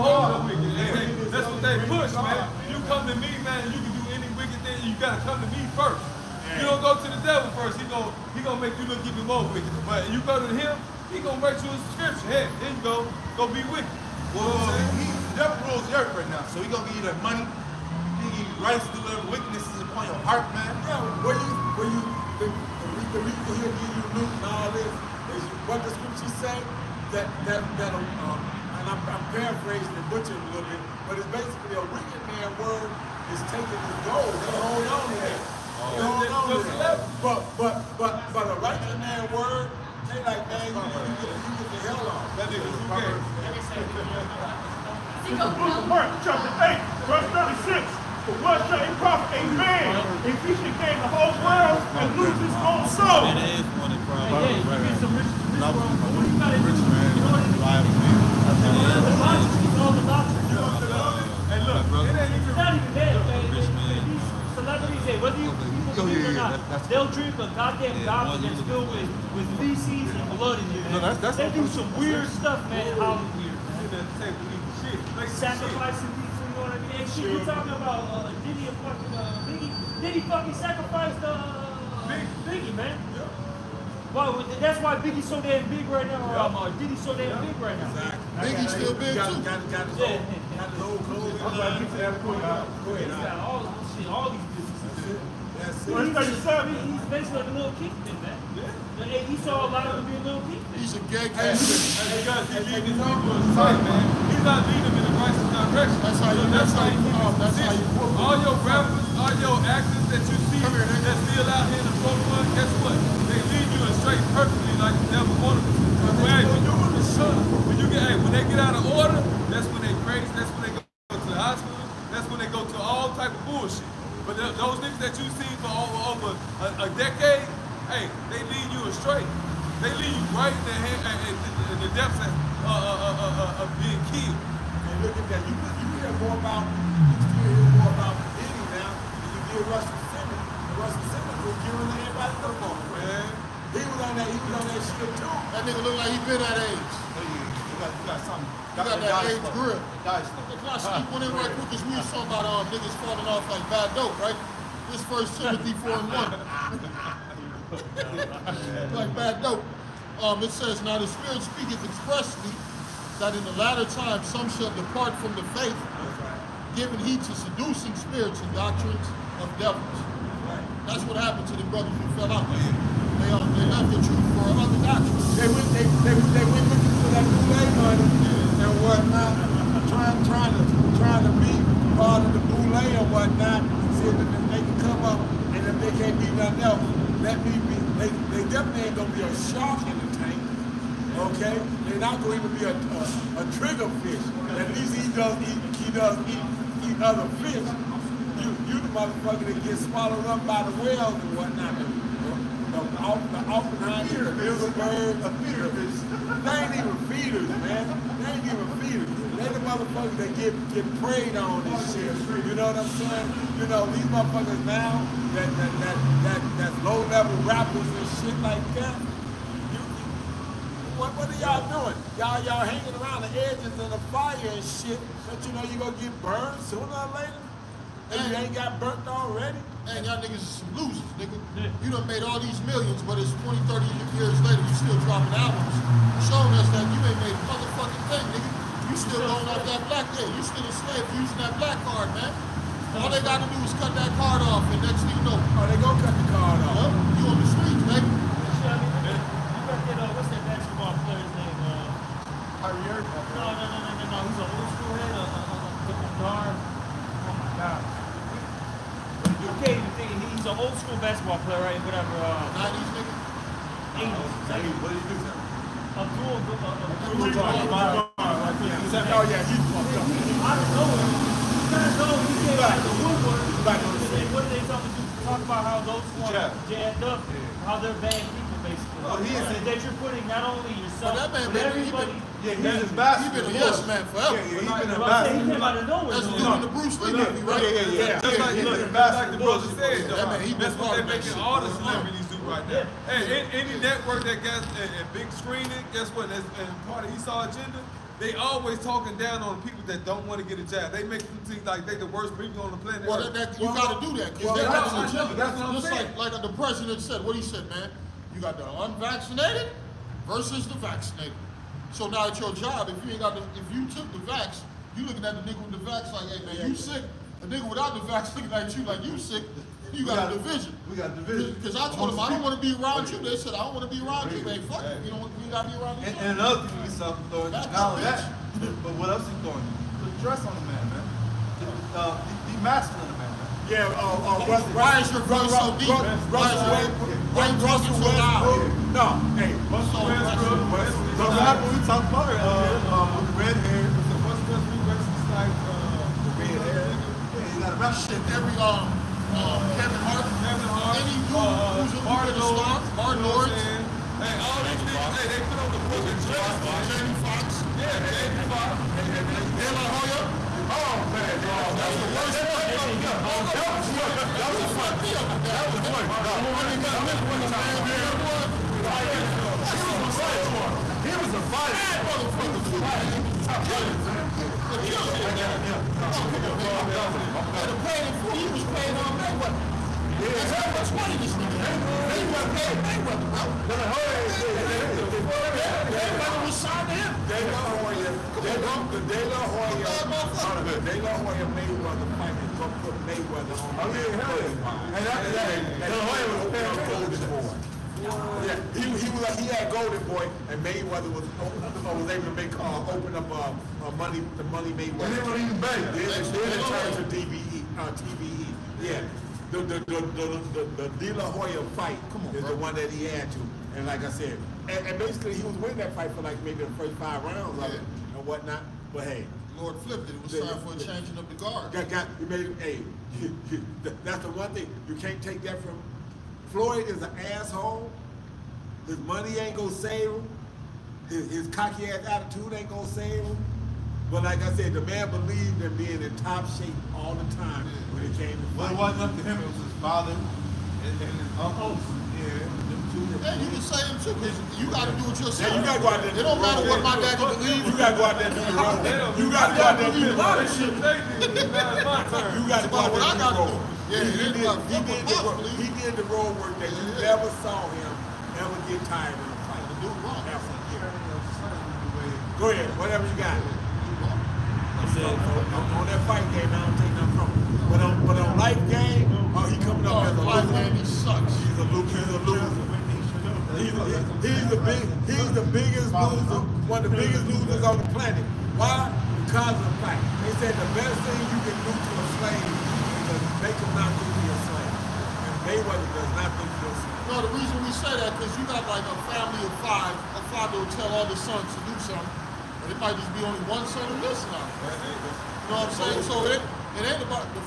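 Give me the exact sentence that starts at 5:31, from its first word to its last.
The, uh, the, the masculine yeah, uh, uh, West, why is your brother so deep?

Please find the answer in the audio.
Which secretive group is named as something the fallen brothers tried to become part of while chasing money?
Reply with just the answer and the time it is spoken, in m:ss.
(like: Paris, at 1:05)
the boule, at 3:02.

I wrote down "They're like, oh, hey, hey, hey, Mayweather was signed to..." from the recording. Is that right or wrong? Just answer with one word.
right.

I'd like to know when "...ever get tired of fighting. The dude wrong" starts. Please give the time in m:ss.
7:38.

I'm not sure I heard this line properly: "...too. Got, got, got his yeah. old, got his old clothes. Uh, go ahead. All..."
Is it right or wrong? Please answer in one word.
right.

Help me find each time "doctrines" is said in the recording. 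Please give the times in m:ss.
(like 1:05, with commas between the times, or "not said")
2:48, 2:54.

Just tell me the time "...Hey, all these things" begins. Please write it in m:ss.
5:54.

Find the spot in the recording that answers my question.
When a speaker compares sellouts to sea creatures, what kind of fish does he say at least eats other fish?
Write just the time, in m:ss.
3:13.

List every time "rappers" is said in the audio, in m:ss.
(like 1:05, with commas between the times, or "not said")
1:48, 3:37.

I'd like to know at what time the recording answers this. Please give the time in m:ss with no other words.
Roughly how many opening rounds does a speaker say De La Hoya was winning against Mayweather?
6:56.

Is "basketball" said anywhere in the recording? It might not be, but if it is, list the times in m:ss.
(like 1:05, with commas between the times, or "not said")
4:20.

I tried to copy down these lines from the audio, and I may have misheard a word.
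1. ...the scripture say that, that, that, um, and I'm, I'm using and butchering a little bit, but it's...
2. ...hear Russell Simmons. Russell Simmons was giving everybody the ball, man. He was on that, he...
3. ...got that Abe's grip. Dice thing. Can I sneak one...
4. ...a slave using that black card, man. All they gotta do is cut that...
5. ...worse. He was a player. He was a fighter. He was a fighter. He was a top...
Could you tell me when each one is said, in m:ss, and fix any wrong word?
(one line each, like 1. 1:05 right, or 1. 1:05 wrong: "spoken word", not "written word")
1. 0:25 wrong: "paraphrasing", not "using"
2. 2:19 right
3. 2:28 right
4. 4:00 right
5. 6:07 wrong: "fighter", not "player".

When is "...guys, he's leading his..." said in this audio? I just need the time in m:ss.
1:42.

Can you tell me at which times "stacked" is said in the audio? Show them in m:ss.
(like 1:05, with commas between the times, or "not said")
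not said.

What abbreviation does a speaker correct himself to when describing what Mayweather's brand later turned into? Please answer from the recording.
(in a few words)
TBE.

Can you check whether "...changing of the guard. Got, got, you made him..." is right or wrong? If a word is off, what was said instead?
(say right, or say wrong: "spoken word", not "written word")
right.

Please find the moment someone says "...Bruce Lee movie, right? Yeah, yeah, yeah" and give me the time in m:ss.
4:46.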